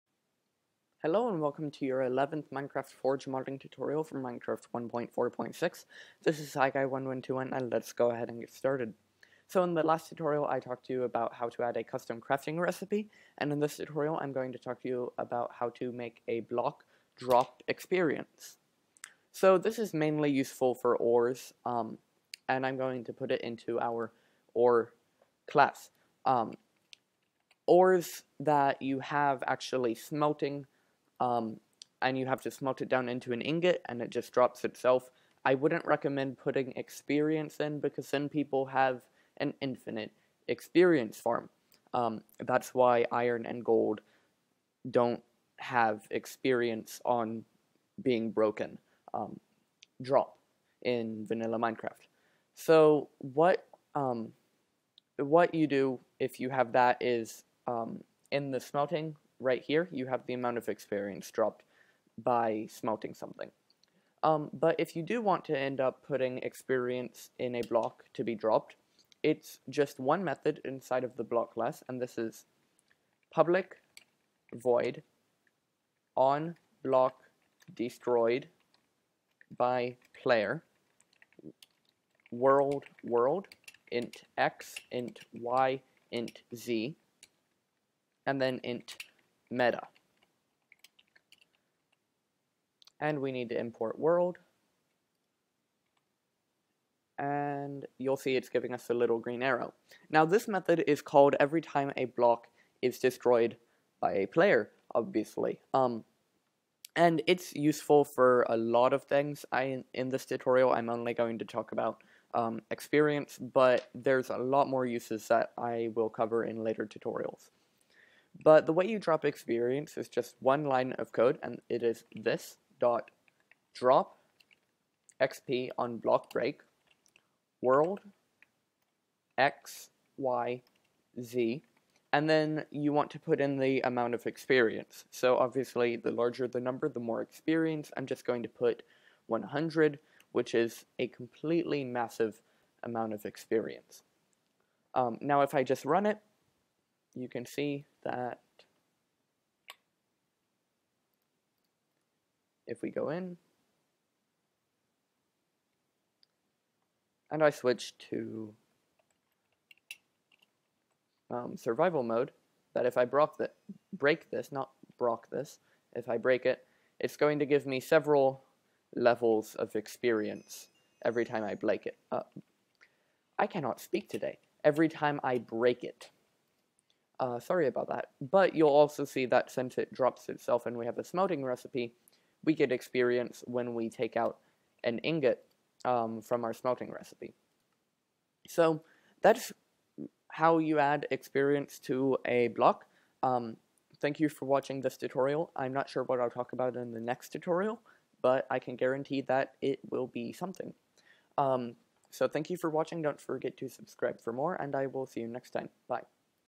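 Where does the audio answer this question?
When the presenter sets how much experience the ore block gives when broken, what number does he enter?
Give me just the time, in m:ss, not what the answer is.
2:19.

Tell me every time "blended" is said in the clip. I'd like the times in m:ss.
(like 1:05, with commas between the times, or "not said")
not said.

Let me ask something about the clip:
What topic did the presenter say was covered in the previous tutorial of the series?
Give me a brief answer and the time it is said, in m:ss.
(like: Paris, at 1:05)
custom crafting recipe, at 0:11.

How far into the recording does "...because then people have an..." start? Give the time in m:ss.
0:37.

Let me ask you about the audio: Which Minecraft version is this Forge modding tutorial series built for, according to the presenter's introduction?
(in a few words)
1.4.6.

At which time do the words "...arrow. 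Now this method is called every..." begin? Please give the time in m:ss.
1:39.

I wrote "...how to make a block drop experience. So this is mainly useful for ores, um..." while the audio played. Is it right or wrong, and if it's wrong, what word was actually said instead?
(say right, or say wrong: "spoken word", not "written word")
right.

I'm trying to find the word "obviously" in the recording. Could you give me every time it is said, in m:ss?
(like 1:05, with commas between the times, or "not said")
1:44, 2:15.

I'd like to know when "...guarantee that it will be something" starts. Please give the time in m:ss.
3:18.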